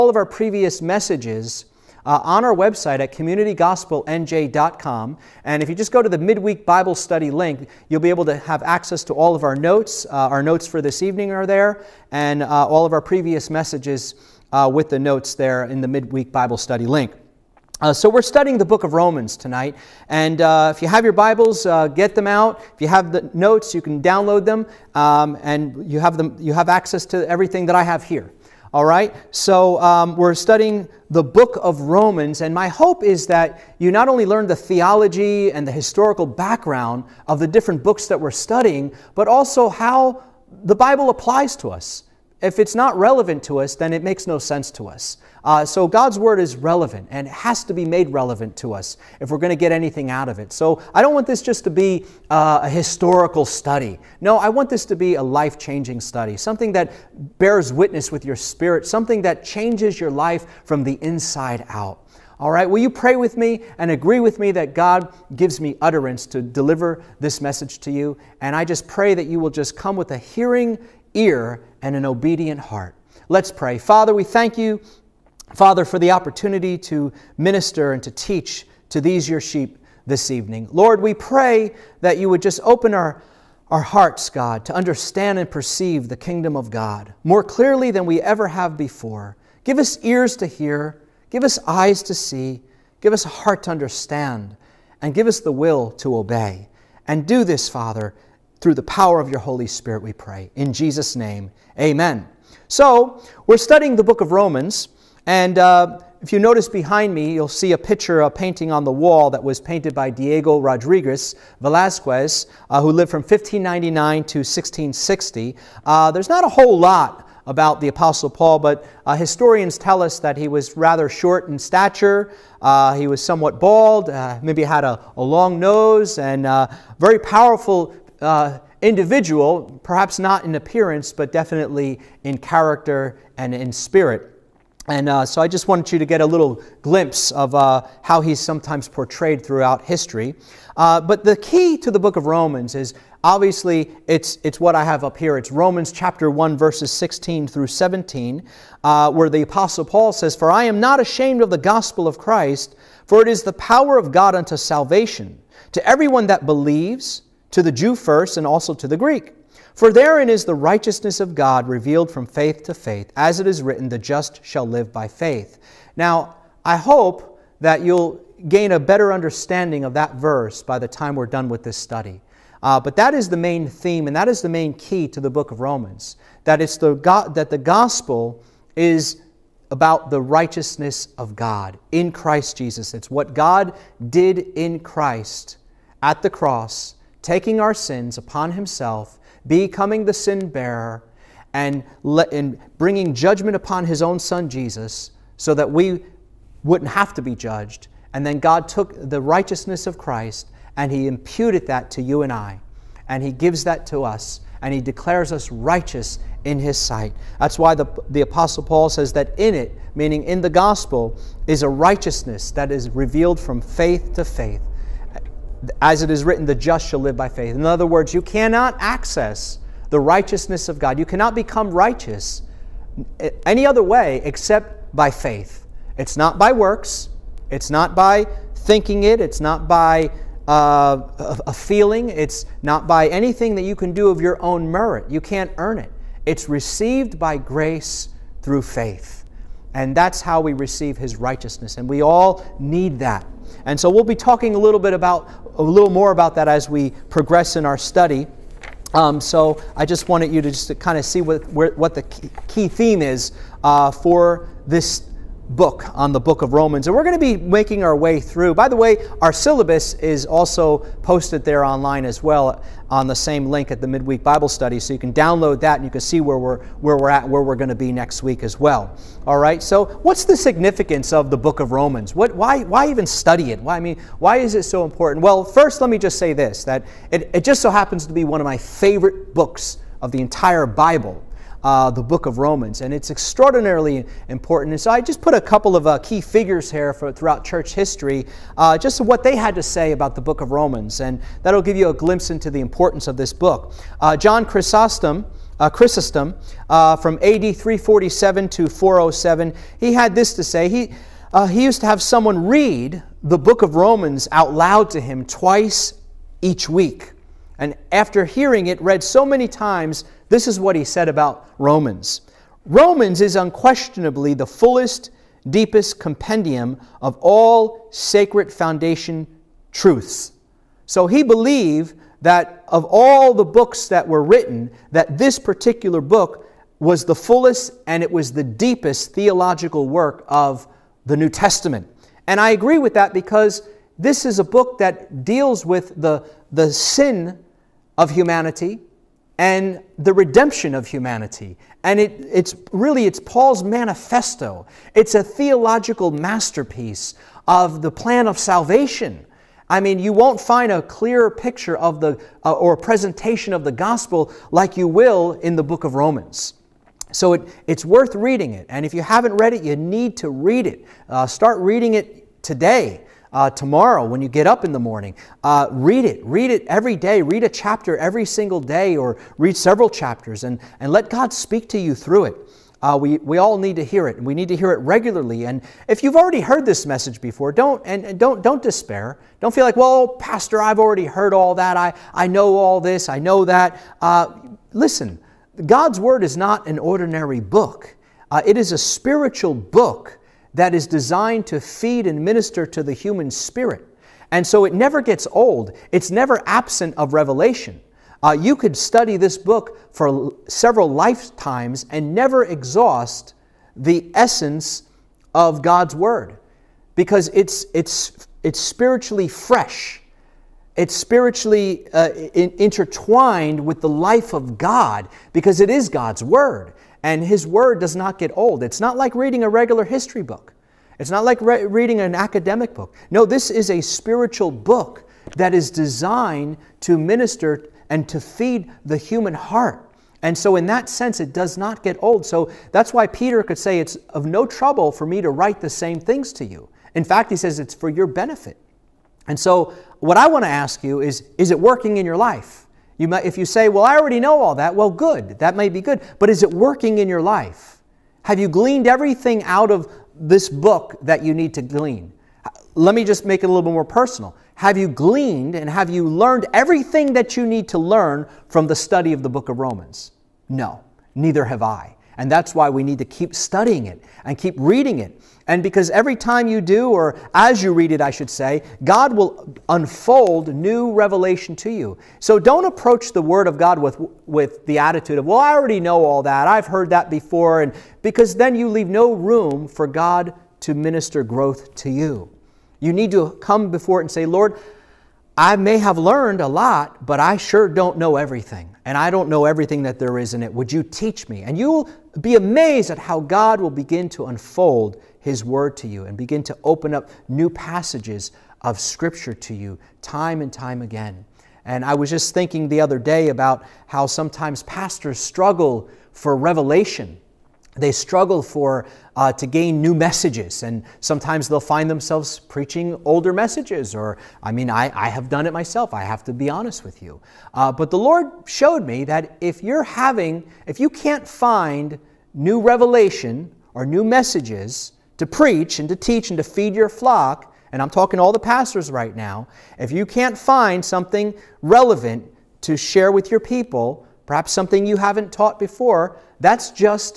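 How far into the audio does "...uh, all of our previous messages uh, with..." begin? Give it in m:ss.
0:12.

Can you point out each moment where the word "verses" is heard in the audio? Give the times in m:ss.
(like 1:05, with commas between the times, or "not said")
2:26, 2:50.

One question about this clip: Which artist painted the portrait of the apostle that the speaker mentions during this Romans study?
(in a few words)
Diego Rodriguez Velazquez.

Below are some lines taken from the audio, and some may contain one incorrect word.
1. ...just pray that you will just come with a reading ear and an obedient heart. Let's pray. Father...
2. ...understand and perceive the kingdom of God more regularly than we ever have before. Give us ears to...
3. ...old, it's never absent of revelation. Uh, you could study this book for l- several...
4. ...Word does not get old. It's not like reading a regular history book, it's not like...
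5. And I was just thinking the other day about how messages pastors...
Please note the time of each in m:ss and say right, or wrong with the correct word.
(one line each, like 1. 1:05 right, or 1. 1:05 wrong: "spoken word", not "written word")
1. 1:08 wrong: "hearing", not "reading"
2. 1:24 wrong: "clearly", not "regularly"
3. 6:35 right
4. 6:57 right
5. 8:21 wrong: "sometimes", not "messages".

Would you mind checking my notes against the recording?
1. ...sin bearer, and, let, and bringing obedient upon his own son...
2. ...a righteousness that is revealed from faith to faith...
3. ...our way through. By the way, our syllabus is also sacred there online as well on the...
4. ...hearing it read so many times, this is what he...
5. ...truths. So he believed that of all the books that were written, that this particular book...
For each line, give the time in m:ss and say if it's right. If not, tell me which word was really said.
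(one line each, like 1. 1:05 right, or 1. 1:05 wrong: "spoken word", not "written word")
1. 3:10 wrong: "judgment", not "obedient"
2. 3:31 right
3. 4:17 wrong: "posted", not "sacred"
4. 5:08 right
5. 5:19 right.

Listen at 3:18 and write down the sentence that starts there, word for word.
And then God took the righteousness of Christ and he imputed that to you and I.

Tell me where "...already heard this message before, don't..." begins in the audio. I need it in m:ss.
6:16.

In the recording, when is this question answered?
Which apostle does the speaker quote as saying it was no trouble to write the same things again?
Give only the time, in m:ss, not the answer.
7:13.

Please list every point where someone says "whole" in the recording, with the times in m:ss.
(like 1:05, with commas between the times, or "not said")
1:56.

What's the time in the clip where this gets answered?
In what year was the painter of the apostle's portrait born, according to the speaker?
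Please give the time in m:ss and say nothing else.
1:53.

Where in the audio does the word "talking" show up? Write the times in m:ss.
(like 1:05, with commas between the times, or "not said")
4:04, 8:47.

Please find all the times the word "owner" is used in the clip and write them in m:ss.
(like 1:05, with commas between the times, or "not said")
not said.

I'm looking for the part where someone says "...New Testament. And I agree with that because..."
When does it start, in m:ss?
5:31.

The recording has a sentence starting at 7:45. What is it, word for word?
And because every time you do, or as you read it, I should say, God will unfold new revelation to you.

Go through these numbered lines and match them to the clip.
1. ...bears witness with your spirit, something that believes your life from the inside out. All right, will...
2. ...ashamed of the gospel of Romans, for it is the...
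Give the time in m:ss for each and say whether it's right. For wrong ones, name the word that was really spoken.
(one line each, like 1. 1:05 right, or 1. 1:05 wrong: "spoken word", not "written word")
1. 0:57 wrong: "changes", not "believes"
2. 2:30 wrong: "Christ", not "Romans".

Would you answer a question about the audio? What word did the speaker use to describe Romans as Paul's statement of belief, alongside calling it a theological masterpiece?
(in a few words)
manifesto.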